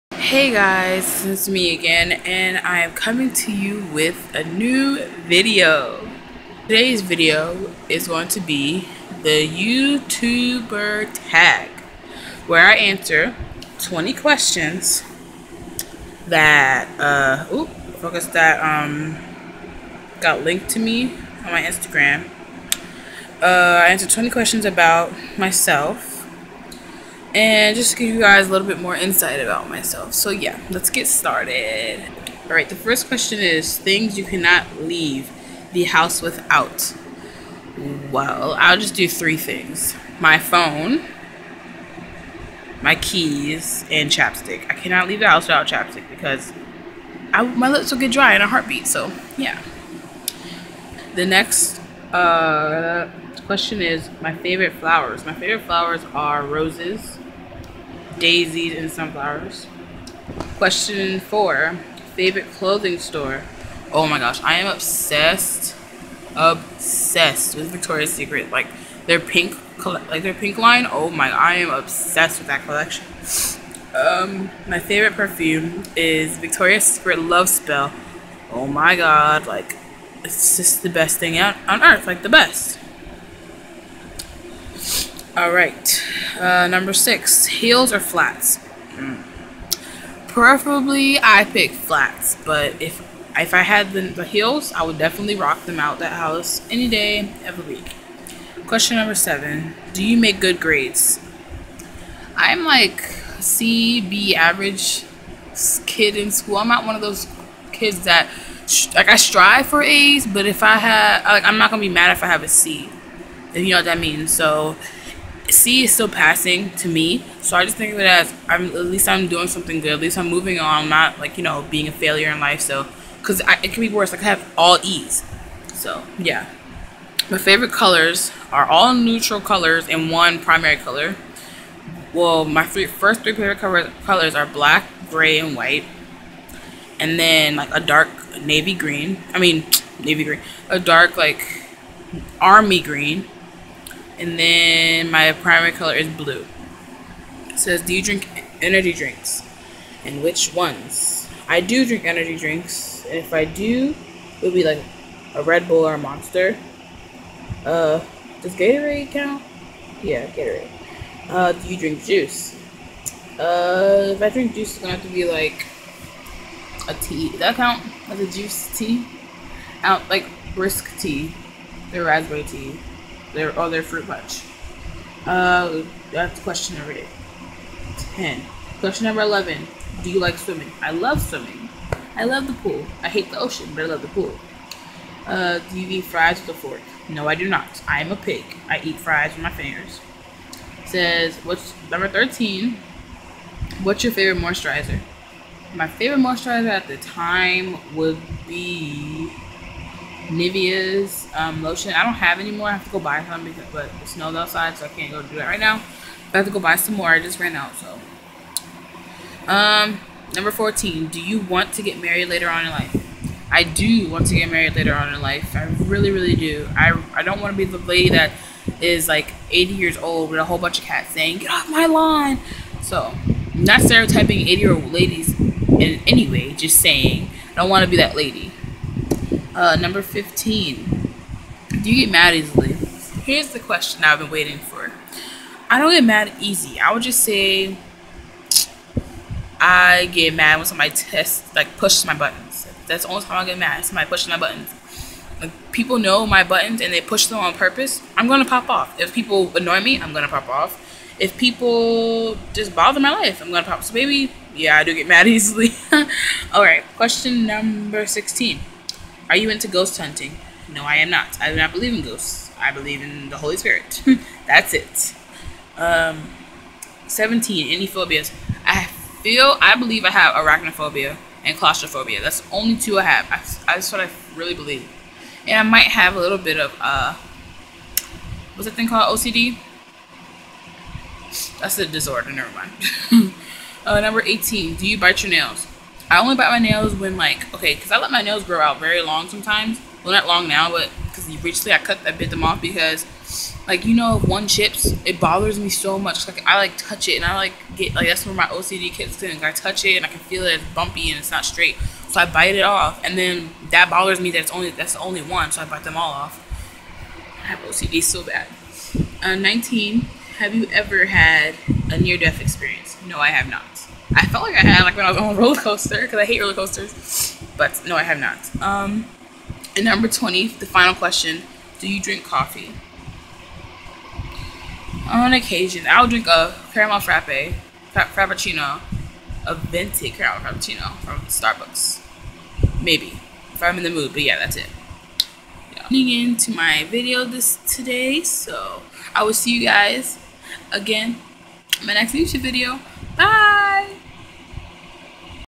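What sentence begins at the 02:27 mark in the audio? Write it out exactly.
It says, do you drink energy drinks?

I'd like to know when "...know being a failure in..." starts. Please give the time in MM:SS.
02:01.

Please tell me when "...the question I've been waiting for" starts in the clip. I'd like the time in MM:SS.
03:53.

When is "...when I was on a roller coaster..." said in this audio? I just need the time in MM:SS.
05:14.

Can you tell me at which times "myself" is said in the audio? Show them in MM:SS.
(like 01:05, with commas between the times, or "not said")
00:25, 00:29.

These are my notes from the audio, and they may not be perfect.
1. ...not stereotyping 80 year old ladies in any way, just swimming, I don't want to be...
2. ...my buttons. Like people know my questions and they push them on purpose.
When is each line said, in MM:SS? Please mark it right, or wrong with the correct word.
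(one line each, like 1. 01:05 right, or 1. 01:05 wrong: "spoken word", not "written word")
1. 03:43 wrong: "saying", not "swimming"
2. 04:04 wrong: "buttons", not "questions".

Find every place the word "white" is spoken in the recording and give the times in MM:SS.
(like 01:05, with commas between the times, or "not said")
02:15.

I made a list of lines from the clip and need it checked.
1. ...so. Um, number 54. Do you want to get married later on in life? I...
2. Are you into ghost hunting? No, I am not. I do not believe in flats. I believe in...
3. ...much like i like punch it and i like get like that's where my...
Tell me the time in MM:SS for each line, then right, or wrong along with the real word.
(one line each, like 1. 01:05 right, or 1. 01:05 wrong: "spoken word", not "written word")
1. 03:27 wrong: "14", not "54"
2. 04:19 wrong: "ghosts", not "flats"
3. 04:55 wrong: "touch", not "punch".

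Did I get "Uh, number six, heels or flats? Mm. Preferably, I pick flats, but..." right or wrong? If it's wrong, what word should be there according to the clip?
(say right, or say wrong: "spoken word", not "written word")
right.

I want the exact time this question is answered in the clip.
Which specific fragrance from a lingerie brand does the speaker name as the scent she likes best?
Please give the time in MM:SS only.
01:17.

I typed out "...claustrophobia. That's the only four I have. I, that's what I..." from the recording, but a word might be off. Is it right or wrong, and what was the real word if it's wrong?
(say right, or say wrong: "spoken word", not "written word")
wrong: "two", not "four".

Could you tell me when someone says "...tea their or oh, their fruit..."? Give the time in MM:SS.
02:52.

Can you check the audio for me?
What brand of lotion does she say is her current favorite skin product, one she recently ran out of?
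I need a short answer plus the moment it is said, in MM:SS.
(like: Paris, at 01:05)
Nivea, at 03:20.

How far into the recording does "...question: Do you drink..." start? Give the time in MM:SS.
05:20.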